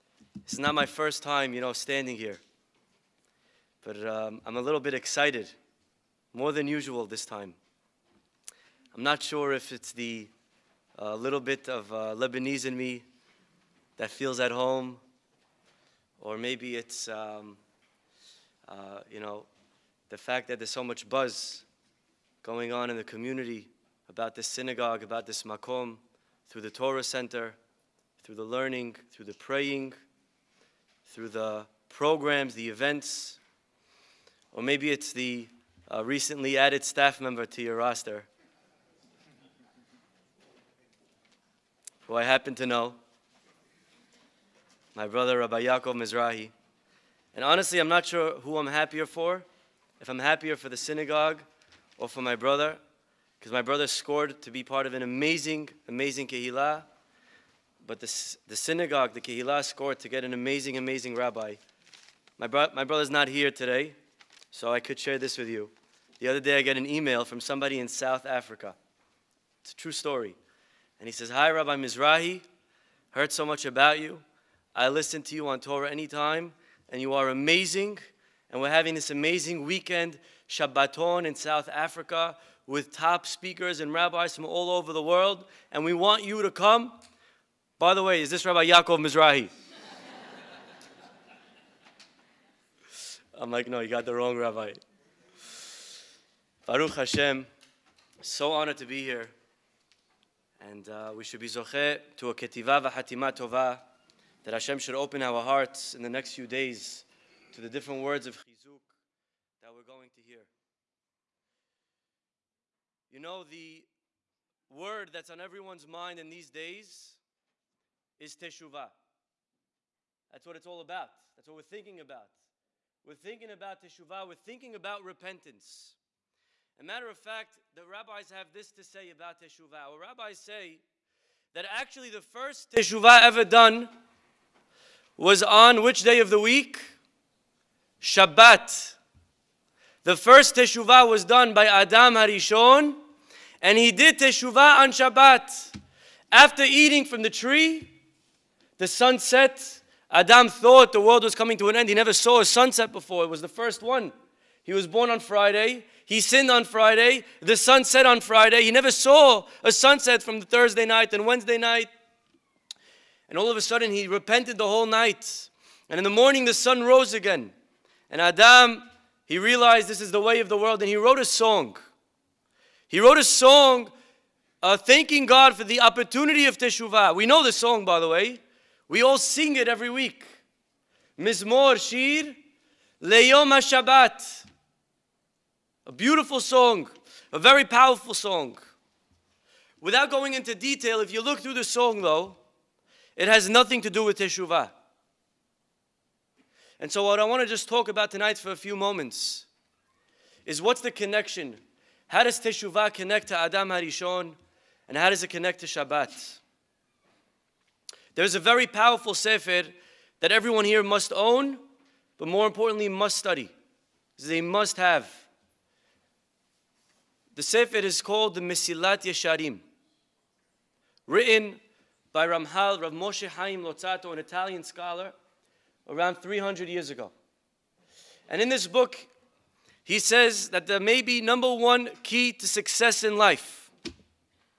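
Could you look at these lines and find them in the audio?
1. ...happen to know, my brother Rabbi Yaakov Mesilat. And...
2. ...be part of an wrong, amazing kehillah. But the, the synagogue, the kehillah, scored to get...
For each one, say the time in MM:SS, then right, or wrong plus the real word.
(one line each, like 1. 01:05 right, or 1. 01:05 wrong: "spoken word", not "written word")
1. 00:42 wrong: "Mizrahi", not "Mesilat"
2. 00:54 wrong: "amazing", not "wrong".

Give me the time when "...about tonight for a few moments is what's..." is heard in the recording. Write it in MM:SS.
03:17.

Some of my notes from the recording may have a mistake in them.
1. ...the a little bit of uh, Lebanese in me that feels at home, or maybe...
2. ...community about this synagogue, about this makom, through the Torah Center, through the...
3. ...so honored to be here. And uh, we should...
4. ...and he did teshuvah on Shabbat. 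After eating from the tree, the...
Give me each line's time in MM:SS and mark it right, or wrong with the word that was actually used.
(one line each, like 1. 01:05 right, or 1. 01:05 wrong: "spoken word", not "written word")
1. 00:09 right
2. 00:23 right
3. 01:38 right
4. 02:23 right.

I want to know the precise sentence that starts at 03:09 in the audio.
Without going into detail, if you look through the song though, it has nothing to do with Teshuvah.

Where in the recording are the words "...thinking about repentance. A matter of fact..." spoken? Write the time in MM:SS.
02:04.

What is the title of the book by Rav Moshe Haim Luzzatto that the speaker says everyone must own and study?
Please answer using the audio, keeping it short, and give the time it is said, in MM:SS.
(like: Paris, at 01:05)
Mesilat Yesharim, at 03:38.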